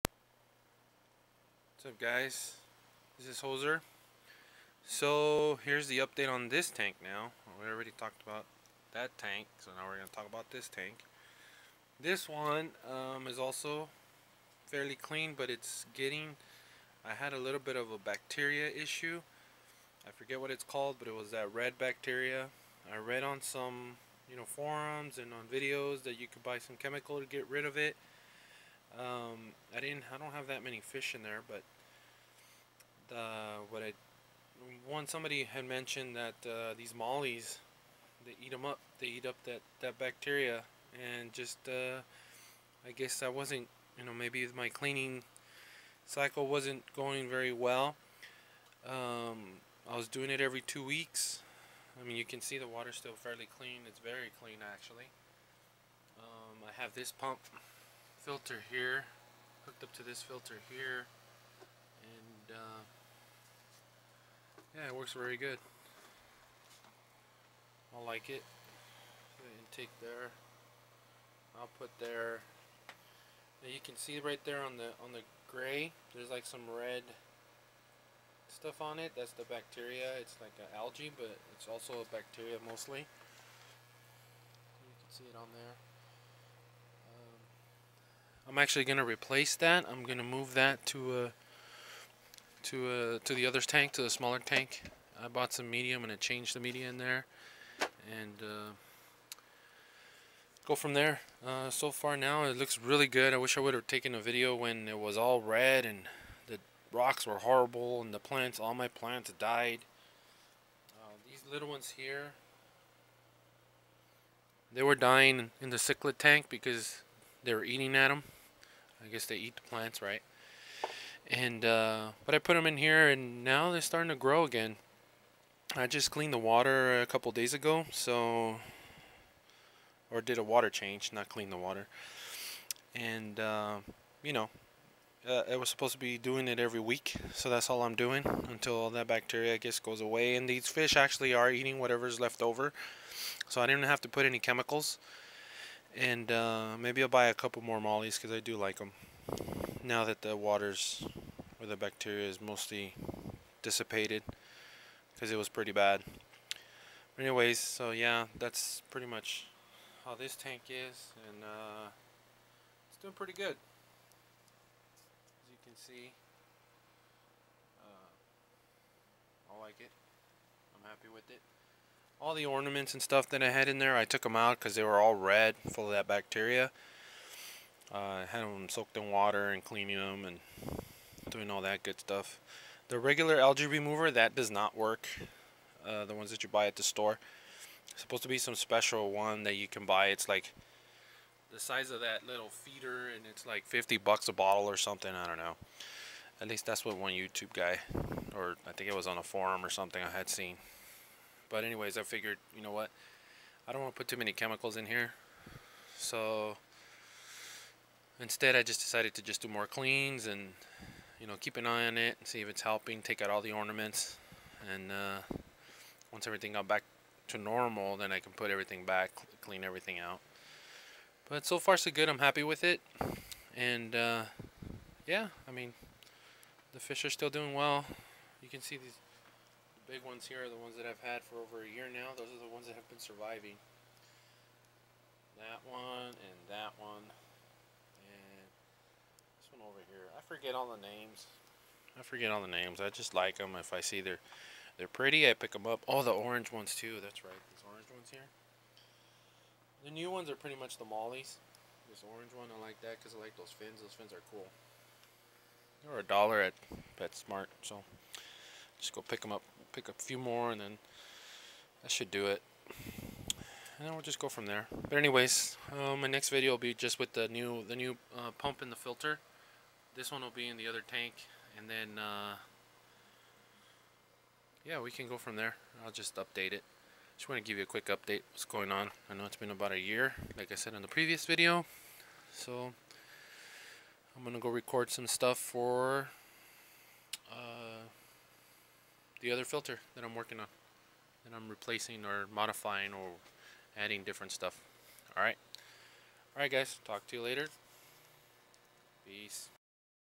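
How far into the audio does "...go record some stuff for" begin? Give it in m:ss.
4:44.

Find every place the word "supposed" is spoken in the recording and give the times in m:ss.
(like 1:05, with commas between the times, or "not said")
2:15, 3:08.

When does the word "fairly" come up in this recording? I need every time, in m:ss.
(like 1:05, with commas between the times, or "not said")
0:14, 0:53.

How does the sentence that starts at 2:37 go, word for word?
anyways, so yeah, that's pretty much how this tank is.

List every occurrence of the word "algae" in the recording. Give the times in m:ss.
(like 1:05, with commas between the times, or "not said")
1:20, 3:03.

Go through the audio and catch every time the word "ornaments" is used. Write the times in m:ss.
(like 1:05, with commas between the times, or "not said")
2:52, 3:33.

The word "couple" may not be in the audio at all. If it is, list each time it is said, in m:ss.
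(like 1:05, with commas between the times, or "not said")
2:07, 2:27.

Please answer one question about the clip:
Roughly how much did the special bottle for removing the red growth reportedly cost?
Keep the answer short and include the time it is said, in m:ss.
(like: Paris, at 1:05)
$50, at 3:13.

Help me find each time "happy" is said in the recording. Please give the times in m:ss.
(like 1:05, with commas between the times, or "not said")
2:50, 3:42.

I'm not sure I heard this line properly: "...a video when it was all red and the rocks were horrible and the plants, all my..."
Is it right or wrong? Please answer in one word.
right.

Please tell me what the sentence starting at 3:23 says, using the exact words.
I don't want to put too many chemicals in here.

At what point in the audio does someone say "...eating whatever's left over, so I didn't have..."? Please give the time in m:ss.
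2:21.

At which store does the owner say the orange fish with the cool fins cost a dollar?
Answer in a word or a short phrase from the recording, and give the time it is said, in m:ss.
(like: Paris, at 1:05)
PetSmart, at 4:16.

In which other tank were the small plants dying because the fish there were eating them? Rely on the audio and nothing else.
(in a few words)
The cichlid tank.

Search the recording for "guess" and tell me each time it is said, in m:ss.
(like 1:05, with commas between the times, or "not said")
0:42, 1:59, 2:19.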